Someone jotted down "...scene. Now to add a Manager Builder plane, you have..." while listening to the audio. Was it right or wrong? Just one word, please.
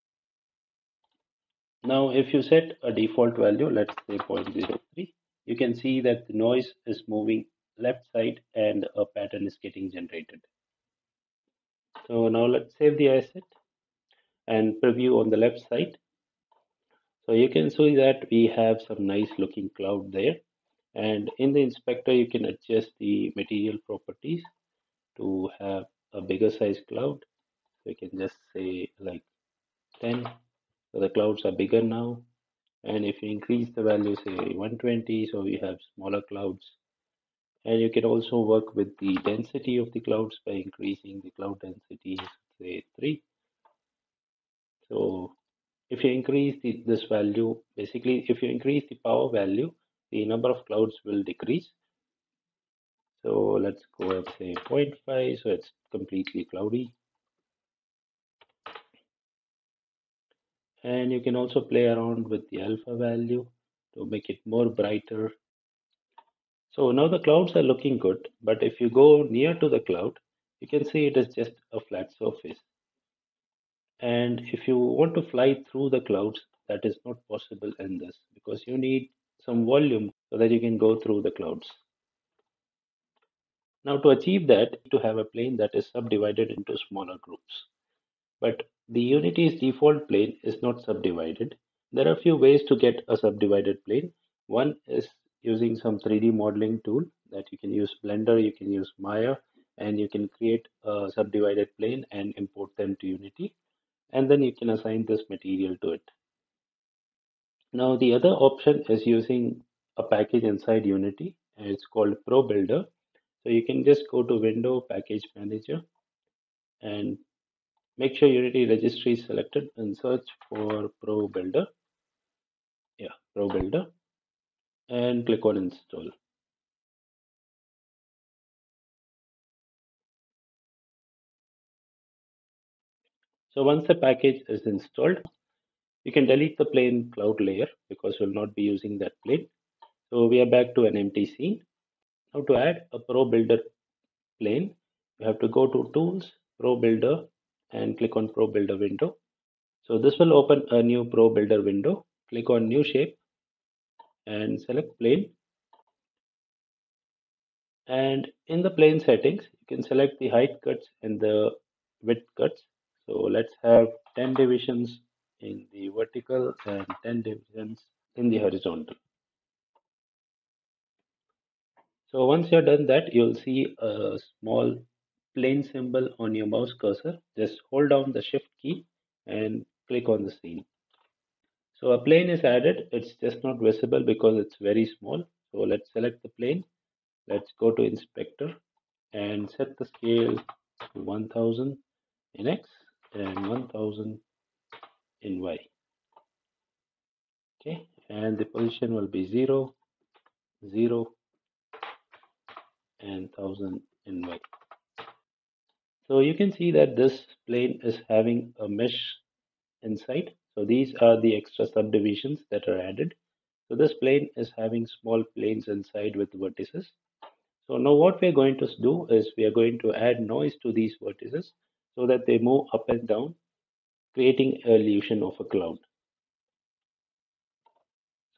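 wrong.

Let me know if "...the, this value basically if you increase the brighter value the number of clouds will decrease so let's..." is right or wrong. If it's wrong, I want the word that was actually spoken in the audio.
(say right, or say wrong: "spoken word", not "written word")
wrong: "power", not "brighter".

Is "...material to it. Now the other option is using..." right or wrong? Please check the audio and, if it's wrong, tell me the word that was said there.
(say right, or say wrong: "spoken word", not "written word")
right.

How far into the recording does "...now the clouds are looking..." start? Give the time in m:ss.
1:06.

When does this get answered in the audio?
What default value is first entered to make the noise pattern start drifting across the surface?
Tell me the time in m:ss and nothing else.
0:04.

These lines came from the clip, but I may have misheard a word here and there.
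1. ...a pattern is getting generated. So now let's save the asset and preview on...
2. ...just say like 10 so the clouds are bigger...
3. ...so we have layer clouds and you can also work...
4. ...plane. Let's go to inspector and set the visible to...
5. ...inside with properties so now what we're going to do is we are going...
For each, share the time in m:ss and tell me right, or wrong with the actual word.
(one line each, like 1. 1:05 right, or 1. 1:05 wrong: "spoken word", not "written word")
1. 0:08 right
2. 0:28 right
3. 0:35 wrong: "smaller", not "layer"
4. 3:06 wrong: "scale", not "visible"
5. 3:35 wrong: "vertices", not "properties".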